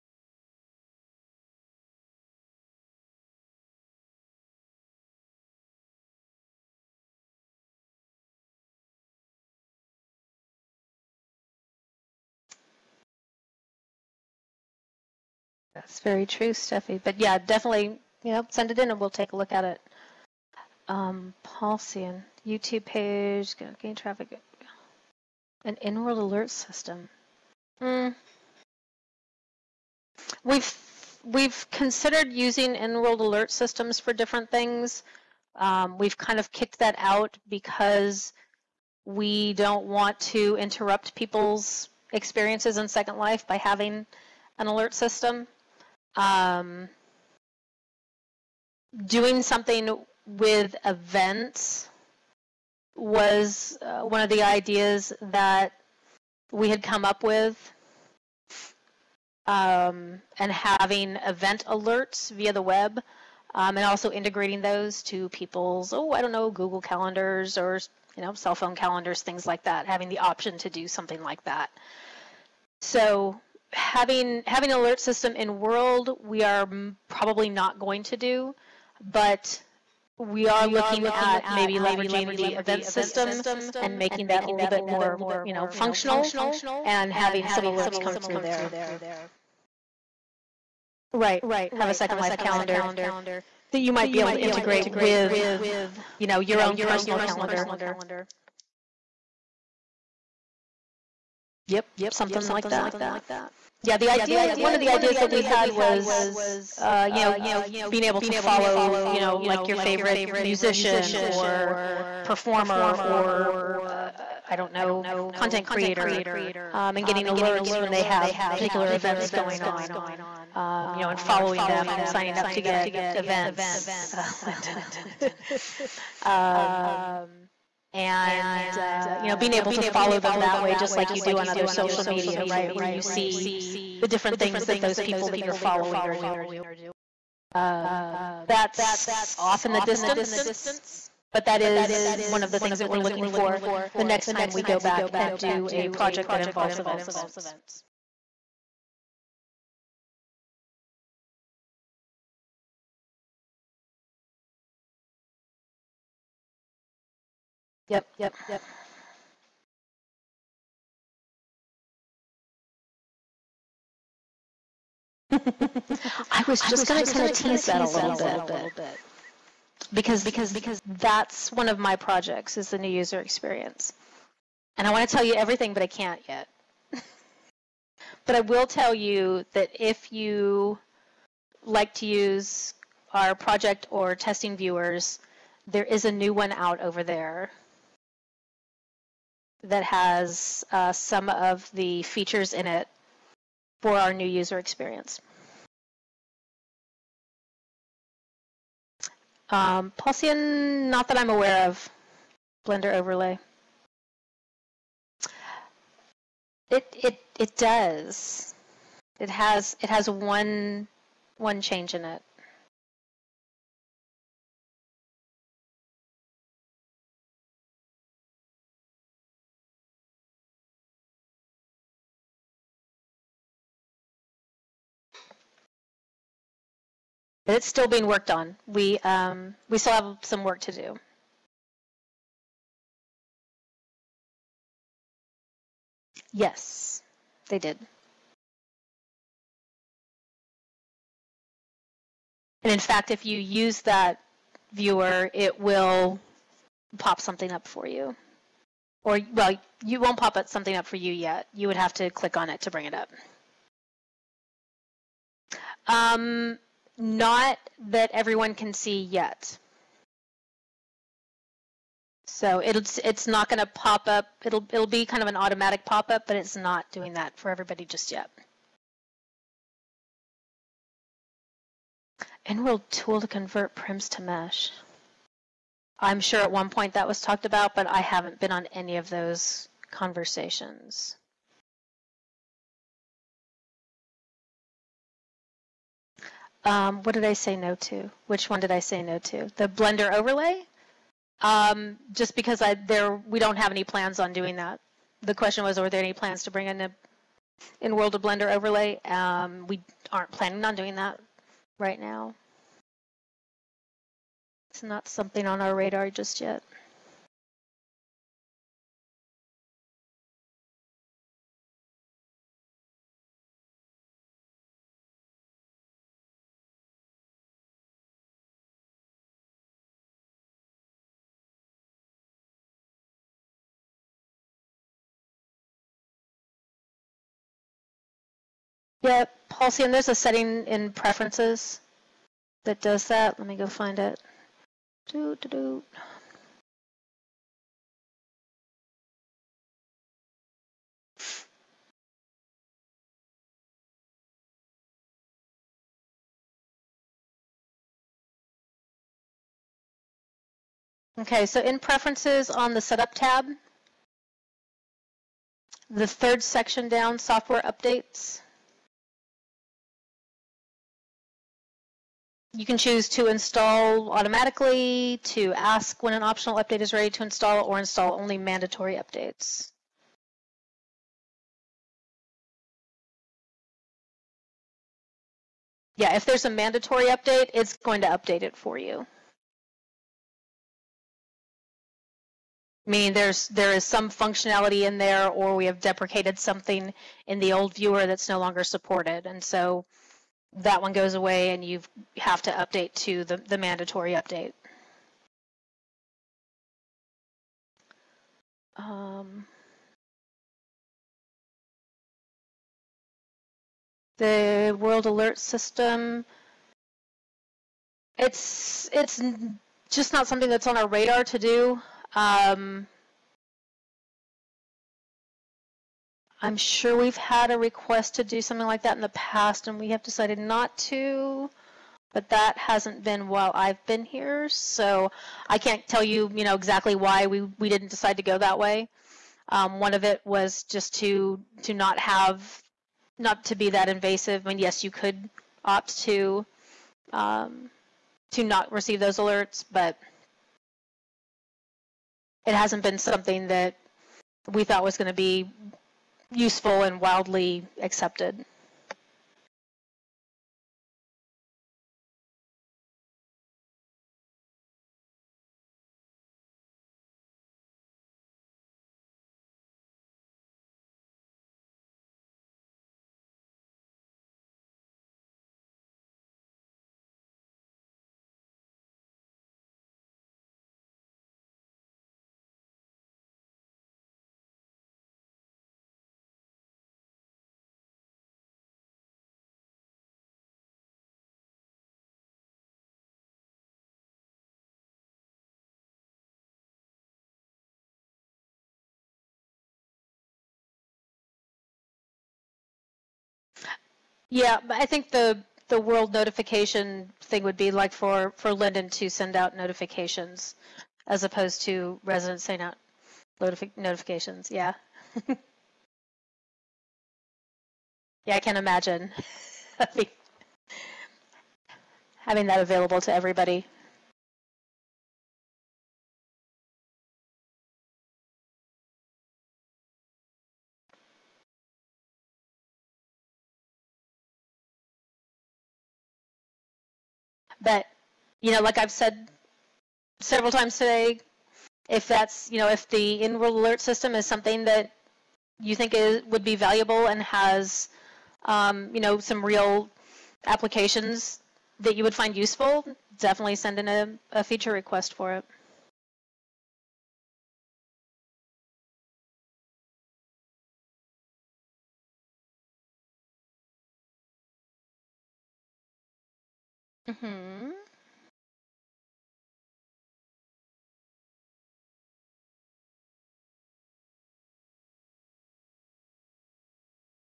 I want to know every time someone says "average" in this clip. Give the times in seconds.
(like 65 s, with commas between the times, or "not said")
not said.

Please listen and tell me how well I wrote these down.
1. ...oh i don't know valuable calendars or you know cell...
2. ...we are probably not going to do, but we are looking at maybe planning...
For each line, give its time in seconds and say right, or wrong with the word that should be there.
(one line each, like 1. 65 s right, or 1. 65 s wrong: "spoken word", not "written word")
1. 65 s wrong: "google", not "valuable"
2. 76 s wrong: "leveraging", not "planning".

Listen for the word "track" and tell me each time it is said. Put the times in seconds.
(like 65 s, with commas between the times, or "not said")
not said.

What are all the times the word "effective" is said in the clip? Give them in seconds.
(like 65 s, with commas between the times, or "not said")
not said.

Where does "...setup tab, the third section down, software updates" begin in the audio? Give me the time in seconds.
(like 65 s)
352 s.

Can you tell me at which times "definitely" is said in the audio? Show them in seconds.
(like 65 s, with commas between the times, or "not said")
17 s, 543 s.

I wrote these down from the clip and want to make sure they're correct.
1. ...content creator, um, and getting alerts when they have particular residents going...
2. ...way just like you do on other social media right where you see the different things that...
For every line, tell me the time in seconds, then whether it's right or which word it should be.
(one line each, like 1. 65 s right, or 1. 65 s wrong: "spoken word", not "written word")
1. 115 s wrong: "events", not "residents"
2. 130 s right.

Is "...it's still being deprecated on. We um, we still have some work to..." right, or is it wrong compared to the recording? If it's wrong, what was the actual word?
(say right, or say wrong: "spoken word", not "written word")
wrong: "worked", not "deprecated".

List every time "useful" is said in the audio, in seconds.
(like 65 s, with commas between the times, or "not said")
446 s, 542 s.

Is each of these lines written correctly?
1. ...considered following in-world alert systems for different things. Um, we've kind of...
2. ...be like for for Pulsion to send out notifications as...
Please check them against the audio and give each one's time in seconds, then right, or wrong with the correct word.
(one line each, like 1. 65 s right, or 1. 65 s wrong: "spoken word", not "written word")
1. 31 s wrong: "using", not "following"
2. 497 s wrong: "Linden", not "Pulsion".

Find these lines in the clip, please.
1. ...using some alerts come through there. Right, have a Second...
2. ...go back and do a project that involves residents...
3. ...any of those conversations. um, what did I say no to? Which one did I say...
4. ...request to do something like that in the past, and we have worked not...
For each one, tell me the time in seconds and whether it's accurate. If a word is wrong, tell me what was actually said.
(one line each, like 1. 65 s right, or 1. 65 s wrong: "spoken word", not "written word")
1. 87 s wrong: "having", not "using"
2. 144 s wrong: "events", not "residents"
3. 278 s right
4. 417 s wrong: "decided", not "worked".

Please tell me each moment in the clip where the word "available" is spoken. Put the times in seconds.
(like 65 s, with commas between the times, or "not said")
512 s.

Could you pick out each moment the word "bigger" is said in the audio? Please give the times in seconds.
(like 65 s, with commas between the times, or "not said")
not said.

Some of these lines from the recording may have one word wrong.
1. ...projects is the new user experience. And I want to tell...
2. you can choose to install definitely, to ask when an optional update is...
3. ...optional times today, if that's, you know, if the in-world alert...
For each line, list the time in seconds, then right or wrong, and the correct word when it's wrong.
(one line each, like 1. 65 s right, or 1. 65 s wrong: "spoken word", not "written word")
1. 171 s right
2. 362 s wrong: "automatically", not "definitely"
3. 530 s wrong: "several", not "optional".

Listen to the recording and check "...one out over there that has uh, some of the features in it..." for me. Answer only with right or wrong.
right.